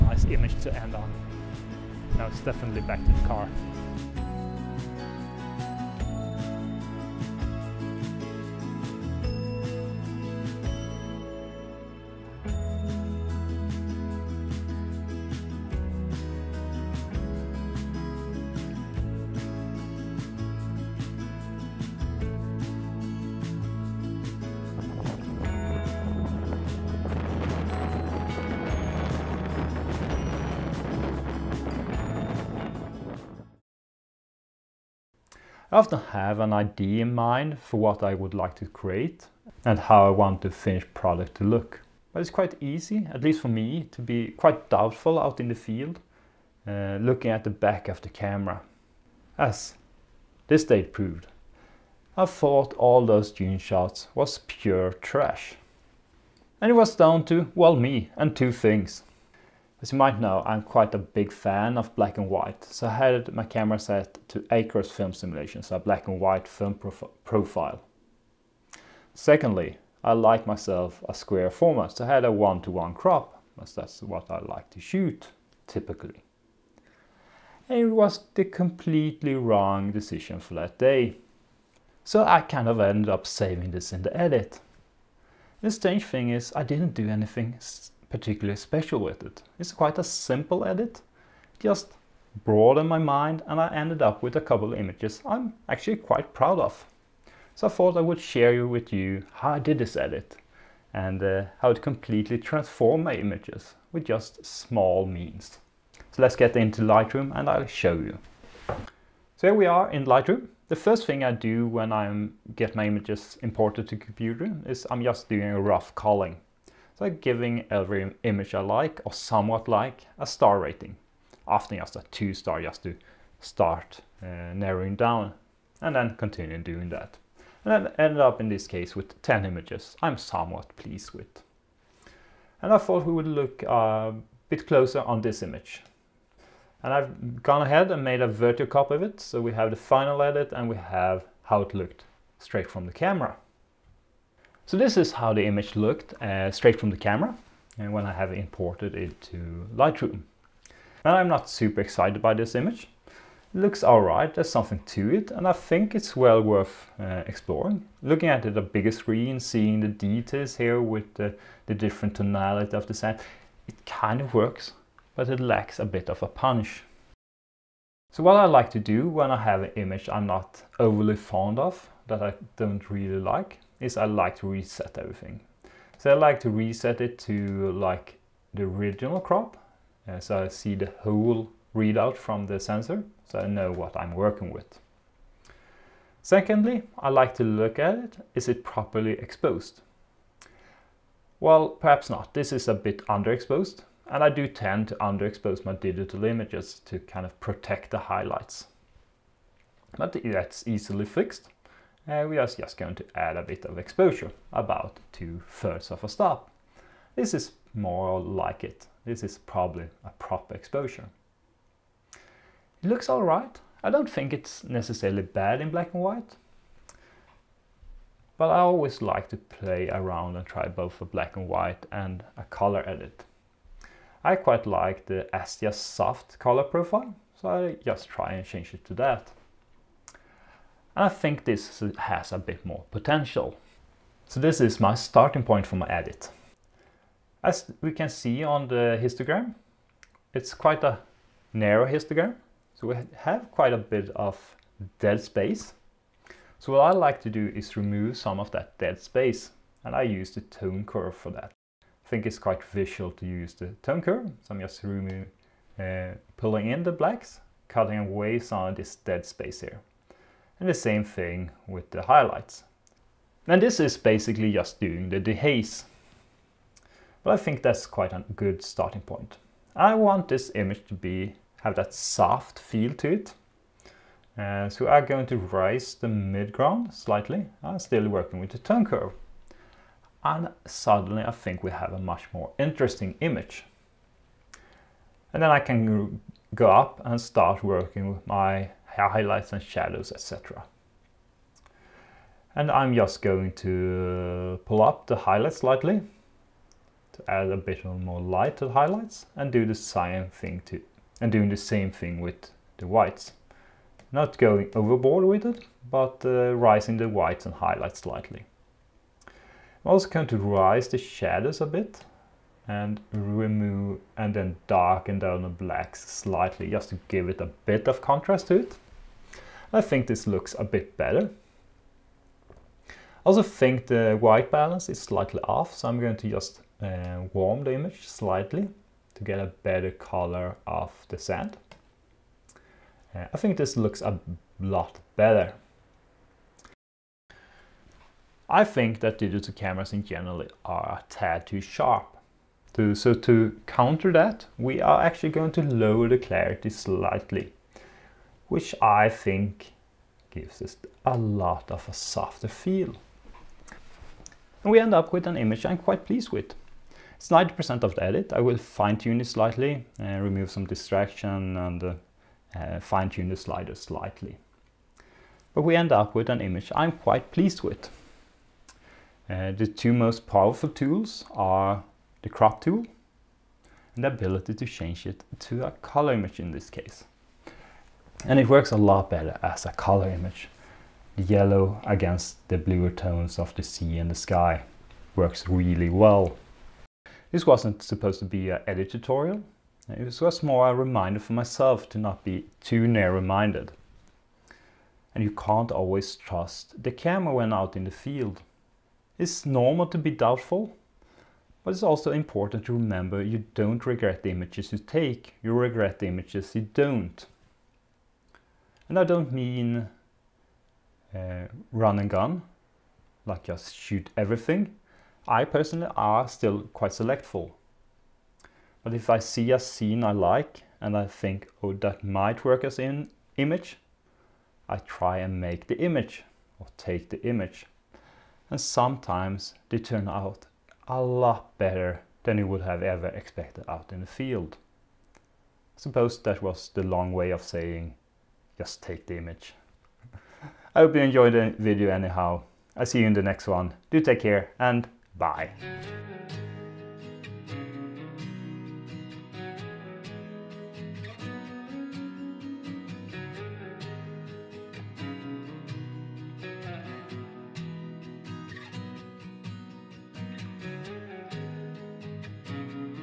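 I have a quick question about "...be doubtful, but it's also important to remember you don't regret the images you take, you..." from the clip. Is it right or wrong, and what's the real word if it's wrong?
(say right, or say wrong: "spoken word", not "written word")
right.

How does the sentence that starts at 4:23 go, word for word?
And this is basically just doing the dehaze.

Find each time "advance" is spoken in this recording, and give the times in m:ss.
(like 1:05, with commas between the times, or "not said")
not said.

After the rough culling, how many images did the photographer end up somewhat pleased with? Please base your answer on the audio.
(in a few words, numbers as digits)
10.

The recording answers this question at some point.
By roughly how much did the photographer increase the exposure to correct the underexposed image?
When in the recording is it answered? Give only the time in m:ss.
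3:25.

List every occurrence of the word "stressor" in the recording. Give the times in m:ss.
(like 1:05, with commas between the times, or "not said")
not said.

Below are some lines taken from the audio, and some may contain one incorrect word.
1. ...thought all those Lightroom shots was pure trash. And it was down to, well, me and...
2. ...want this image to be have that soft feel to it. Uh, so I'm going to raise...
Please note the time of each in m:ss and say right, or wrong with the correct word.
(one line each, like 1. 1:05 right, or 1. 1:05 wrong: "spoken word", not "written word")
1. 0:52 wrong: "June", not "Lightroom"
2. 4:29 right.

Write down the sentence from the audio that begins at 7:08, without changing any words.
And sometimes they turn out a lot better than you would have ever expected out in the field.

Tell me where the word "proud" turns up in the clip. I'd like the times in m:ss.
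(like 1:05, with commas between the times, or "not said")
1:36.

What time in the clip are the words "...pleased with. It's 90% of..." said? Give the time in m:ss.
5:56.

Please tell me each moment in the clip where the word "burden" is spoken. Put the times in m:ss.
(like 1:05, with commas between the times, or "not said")
not said.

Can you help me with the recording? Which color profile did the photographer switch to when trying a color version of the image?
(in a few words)
Astia Soft.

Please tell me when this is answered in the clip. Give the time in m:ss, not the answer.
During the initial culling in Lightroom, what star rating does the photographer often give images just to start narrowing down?
2:02.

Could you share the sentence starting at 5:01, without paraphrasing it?
And doing the same thing with the whites.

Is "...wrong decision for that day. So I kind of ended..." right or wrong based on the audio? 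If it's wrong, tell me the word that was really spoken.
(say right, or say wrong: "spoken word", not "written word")
right.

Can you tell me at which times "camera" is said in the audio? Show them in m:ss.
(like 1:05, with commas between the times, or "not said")
0:48, 1:03, 2:22, 2:26, 5:39, 6:36.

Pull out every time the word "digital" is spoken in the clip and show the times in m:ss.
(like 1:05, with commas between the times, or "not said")
3:15, 5:39.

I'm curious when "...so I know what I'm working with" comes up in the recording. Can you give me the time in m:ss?
3:03.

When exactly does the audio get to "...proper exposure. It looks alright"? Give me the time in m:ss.
3:30.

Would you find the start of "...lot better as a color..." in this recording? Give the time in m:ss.
6:18.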